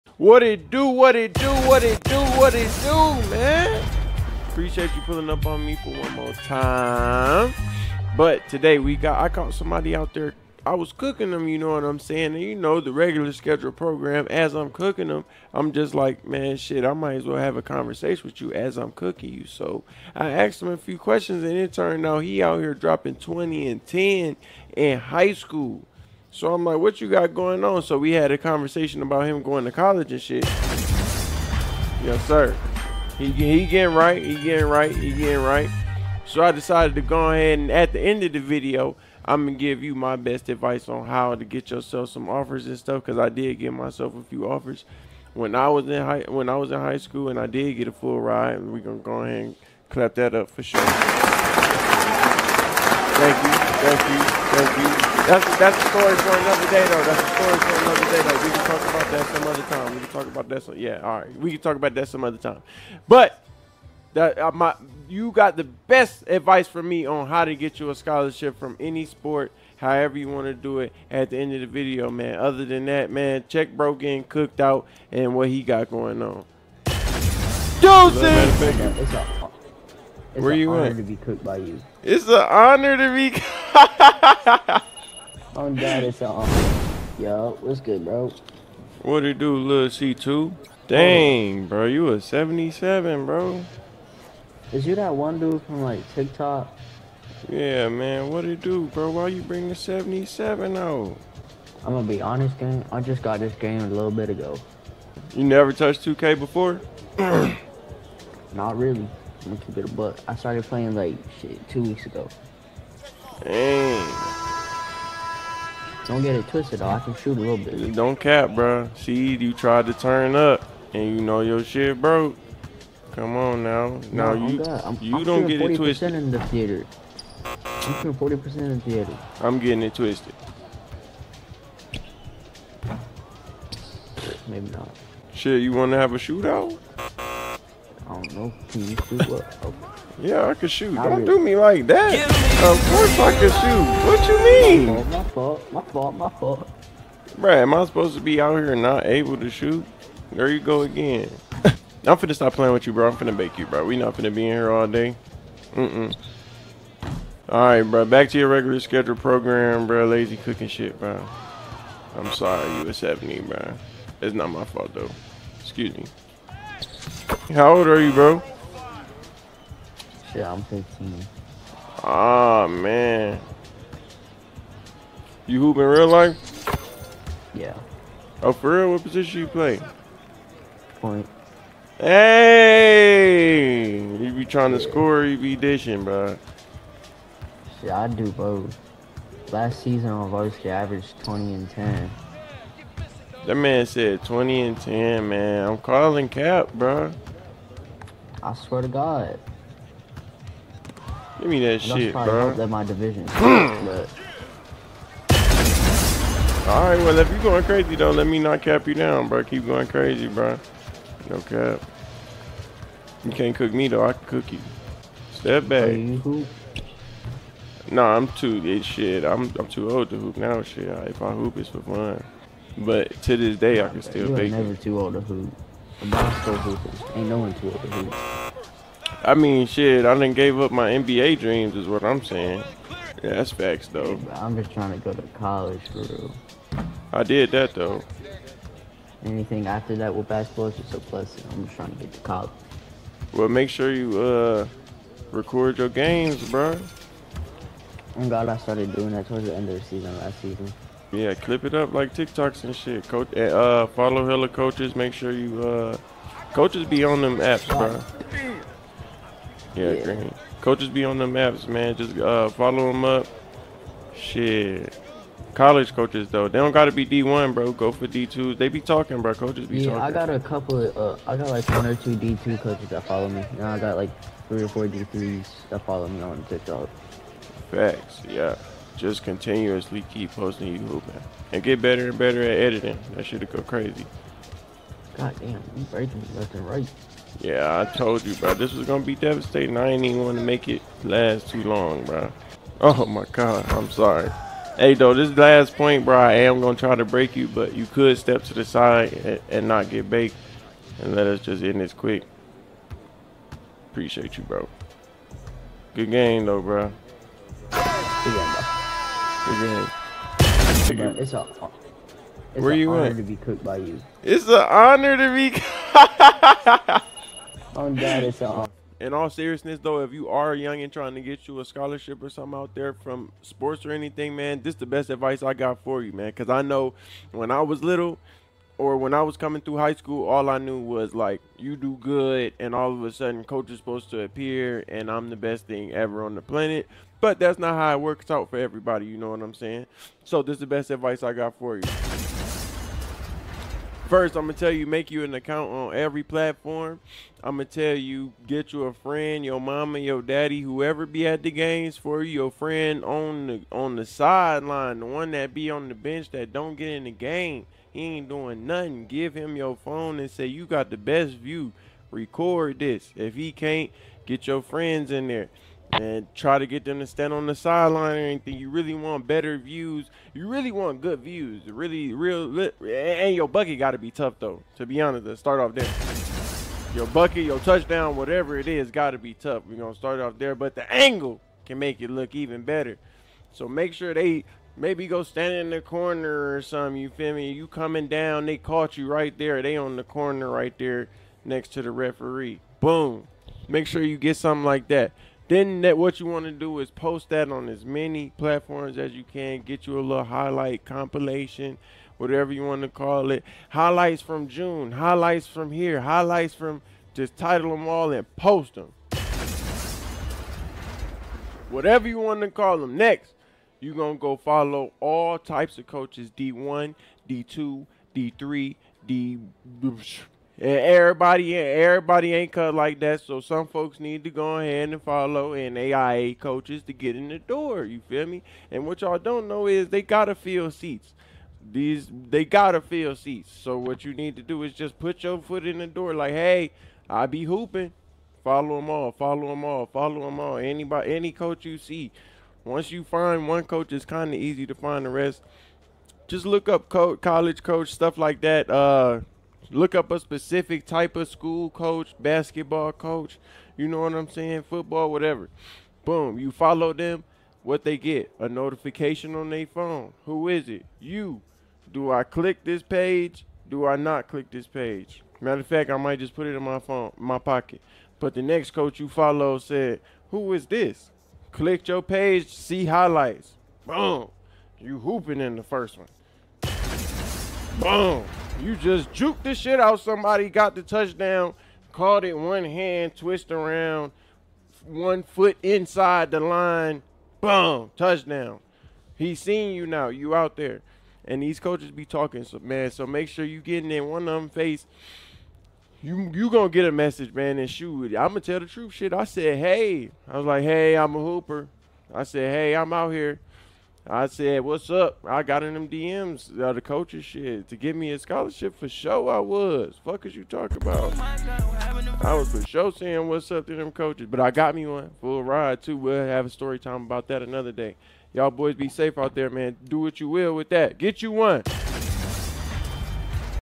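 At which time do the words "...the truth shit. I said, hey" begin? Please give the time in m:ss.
8:18.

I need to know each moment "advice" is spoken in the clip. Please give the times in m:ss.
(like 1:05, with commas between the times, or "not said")
0:40, 1:06, 5:25, 5:40.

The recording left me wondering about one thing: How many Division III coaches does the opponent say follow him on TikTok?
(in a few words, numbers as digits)
three or four.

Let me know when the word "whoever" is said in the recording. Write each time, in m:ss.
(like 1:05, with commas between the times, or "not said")
5:50.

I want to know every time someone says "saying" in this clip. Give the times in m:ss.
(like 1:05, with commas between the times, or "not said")
0:11, 3:52, 5:39, 7:34, 8:32.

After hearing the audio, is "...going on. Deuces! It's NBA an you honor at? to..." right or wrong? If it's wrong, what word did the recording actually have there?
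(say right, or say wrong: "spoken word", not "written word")
wrong: "Where", not "NBA".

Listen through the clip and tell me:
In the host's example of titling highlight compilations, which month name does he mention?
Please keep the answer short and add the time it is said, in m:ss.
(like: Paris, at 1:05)
June, at 6:44.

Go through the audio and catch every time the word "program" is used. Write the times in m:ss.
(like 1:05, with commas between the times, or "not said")
0:13, 2:39.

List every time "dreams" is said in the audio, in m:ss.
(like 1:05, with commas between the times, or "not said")
3:51.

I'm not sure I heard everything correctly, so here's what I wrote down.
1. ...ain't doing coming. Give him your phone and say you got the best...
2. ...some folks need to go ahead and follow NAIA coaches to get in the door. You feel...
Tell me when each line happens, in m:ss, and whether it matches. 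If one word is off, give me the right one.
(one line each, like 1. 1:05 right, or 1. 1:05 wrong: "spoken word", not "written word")
1. 5:58 wrong: "nothing", not "coming"
2. 7:03 right.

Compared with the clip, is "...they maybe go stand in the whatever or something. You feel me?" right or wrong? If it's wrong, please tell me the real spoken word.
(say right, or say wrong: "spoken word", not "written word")
wrong: "corner", not "whatever".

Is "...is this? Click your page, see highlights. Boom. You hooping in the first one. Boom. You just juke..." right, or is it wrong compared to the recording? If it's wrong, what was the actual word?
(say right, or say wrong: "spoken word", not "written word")
right.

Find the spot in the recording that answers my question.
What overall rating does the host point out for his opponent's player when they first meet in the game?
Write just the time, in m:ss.
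1:32.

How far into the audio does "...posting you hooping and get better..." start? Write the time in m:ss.
4:40.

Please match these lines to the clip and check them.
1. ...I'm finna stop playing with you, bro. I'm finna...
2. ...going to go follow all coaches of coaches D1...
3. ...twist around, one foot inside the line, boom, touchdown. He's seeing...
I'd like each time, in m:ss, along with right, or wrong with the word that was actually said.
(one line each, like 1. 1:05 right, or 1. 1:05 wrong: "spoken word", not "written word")
1. 2:31 right
2. 6:53 wrong: "types", not "coaches"
3. 8:03 right.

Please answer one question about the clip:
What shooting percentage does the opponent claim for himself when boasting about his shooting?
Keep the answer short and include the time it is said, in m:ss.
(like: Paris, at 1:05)
40%, at 2:08.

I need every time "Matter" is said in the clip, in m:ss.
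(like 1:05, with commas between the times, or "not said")
7:45.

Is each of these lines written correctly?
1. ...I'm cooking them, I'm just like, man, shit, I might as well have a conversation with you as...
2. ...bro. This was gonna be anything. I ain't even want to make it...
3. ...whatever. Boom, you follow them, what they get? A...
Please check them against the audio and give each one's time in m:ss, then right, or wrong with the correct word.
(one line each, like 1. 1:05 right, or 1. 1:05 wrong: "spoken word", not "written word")
1. 0:14 right
2. 4:48 wrong: "devastating", not "anything"
3. 7:35 right.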